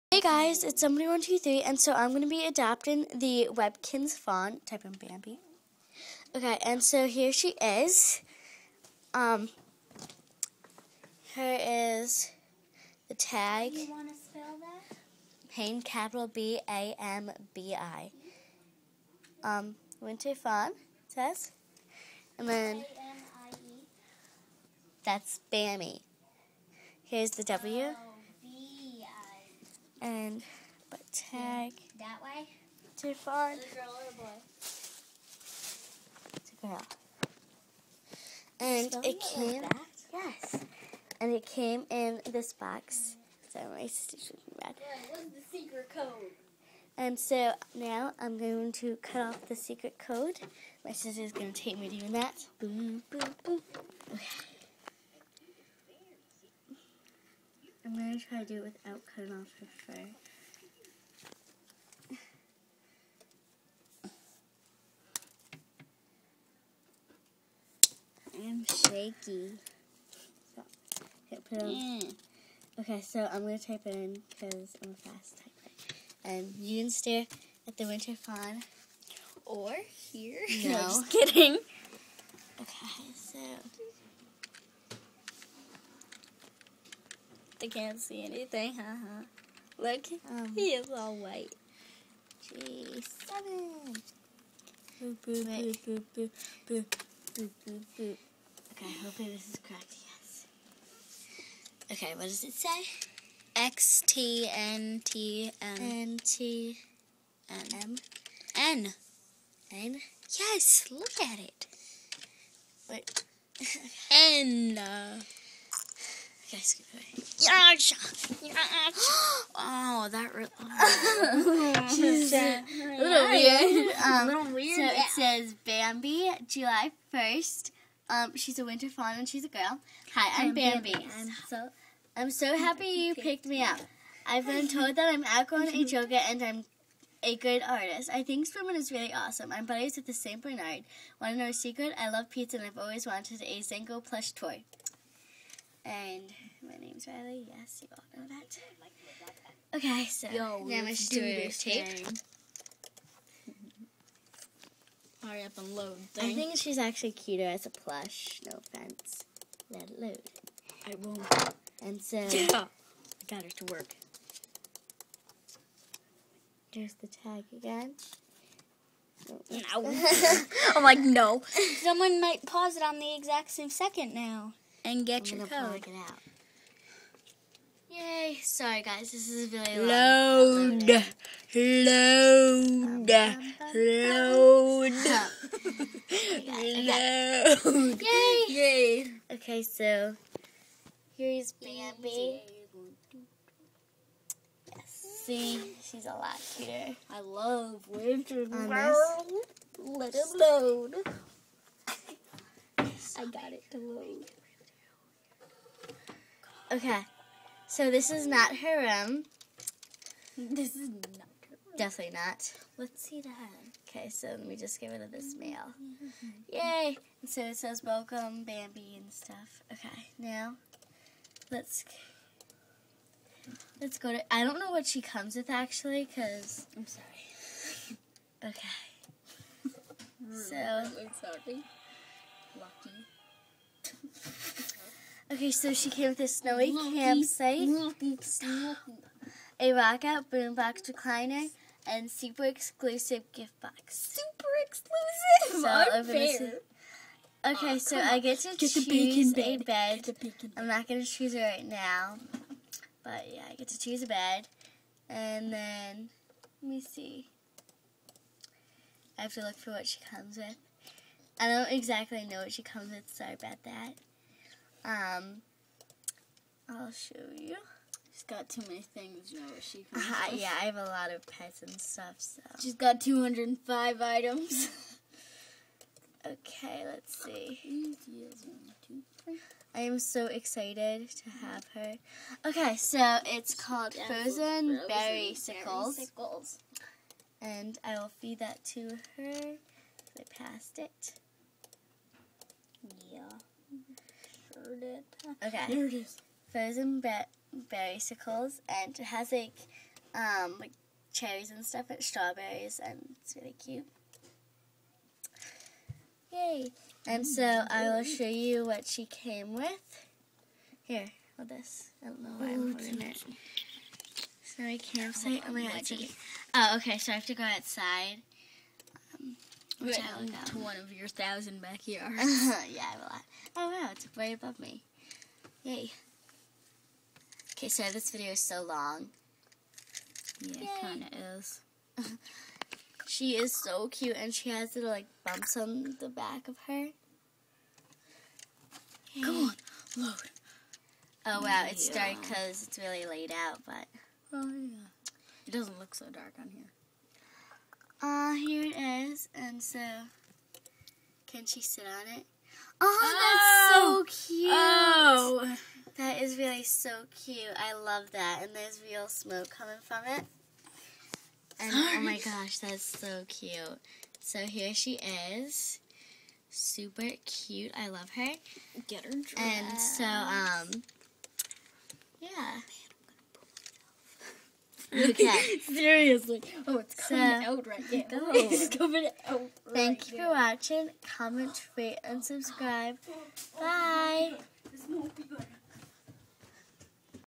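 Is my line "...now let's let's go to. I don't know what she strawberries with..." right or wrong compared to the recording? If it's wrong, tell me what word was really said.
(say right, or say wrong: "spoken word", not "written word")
wrong: "comes", not "strawberries".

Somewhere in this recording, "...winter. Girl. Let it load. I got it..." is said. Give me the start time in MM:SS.
03:17.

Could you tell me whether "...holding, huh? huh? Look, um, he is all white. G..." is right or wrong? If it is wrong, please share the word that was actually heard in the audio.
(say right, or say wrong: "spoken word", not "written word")
wrong: "anything", not "holding".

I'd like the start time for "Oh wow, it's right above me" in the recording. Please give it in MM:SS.
05:23.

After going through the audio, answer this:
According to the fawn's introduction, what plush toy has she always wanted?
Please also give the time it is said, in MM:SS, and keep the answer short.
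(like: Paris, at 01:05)
Zango plush toy, at 02:23.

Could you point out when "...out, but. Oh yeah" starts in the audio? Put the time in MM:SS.
05:43.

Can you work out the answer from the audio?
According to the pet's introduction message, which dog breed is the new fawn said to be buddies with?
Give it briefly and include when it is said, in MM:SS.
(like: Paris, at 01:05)
St. Bernard, at 02:20.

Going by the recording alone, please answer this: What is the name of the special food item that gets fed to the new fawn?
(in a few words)
Frozen Berry Sickles.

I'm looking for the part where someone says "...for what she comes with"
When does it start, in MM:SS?
04:19.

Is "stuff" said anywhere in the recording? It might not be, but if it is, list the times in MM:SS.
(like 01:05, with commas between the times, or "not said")
03:39, 04:31, 05:01.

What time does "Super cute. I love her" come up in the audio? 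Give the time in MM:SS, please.
06:06.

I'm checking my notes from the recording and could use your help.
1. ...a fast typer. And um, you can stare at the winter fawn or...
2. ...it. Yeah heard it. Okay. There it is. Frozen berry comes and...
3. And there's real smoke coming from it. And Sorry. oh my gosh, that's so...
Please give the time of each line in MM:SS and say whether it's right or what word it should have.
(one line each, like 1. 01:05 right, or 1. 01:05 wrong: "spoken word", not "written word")
1. 01:14 right
2. 04:50 wrong: "berrycicles", not "comes"
3. 05:58 right.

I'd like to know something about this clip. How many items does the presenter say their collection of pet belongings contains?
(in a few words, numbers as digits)
205.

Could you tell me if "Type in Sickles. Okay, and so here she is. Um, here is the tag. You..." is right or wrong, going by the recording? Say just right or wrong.
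wrong.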